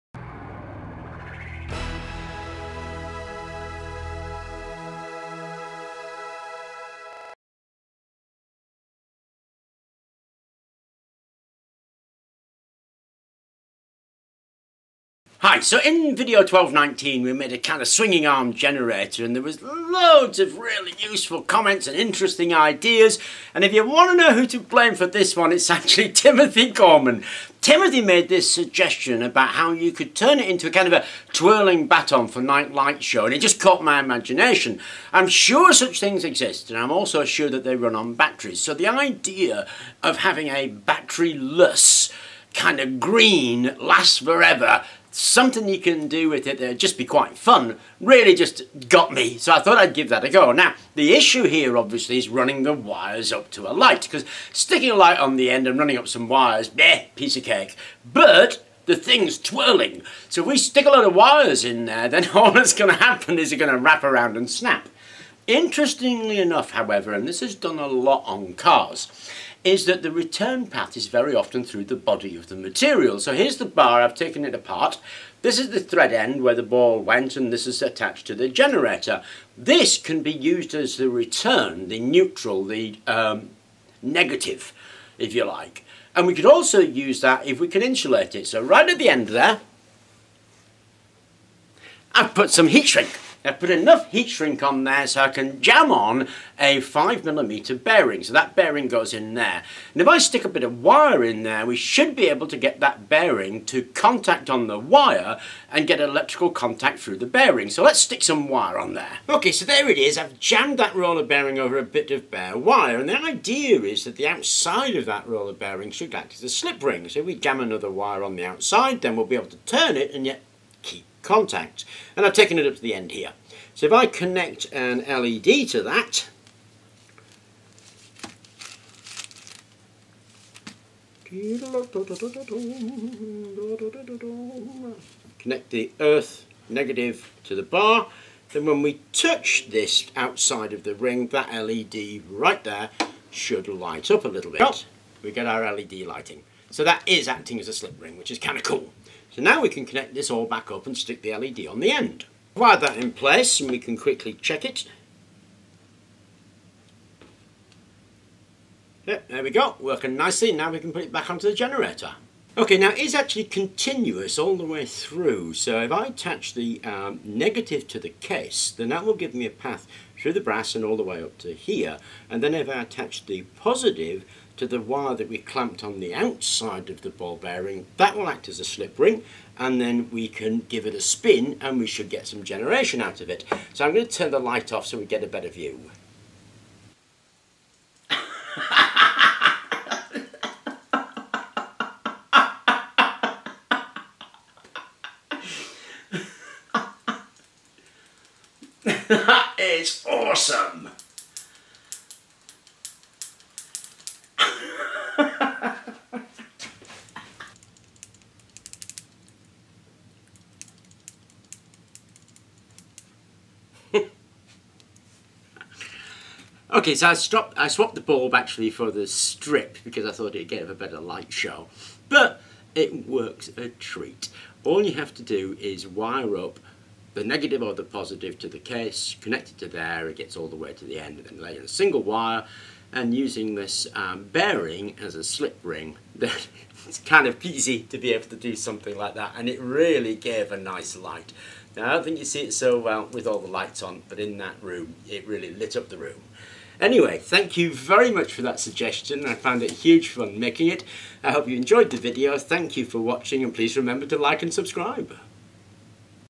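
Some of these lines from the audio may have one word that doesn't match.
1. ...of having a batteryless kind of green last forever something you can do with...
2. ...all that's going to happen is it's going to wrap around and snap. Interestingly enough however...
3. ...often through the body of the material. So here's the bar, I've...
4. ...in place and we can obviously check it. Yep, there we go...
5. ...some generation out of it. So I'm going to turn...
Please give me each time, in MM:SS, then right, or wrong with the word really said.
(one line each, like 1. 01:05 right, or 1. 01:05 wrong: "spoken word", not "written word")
1. 00:40 right
2. 01:02 right
3. 01:11 right
4. 02:32 wrong: "quickly", not "obviously"
5. 03:02 right.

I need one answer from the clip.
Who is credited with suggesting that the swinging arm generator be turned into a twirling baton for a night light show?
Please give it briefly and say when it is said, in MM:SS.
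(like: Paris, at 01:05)
Timothy Gorman, at 00:26.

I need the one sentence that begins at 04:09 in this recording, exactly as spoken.
I found it huge fun making it.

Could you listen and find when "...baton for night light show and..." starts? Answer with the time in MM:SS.
00:31.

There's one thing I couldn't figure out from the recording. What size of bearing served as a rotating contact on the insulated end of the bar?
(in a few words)
5mm.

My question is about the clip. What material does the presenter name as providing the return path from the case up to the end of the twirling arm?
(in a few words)
Brass.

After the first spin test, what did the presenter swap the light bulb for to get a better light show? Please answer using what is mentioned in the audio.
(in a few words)
The strip.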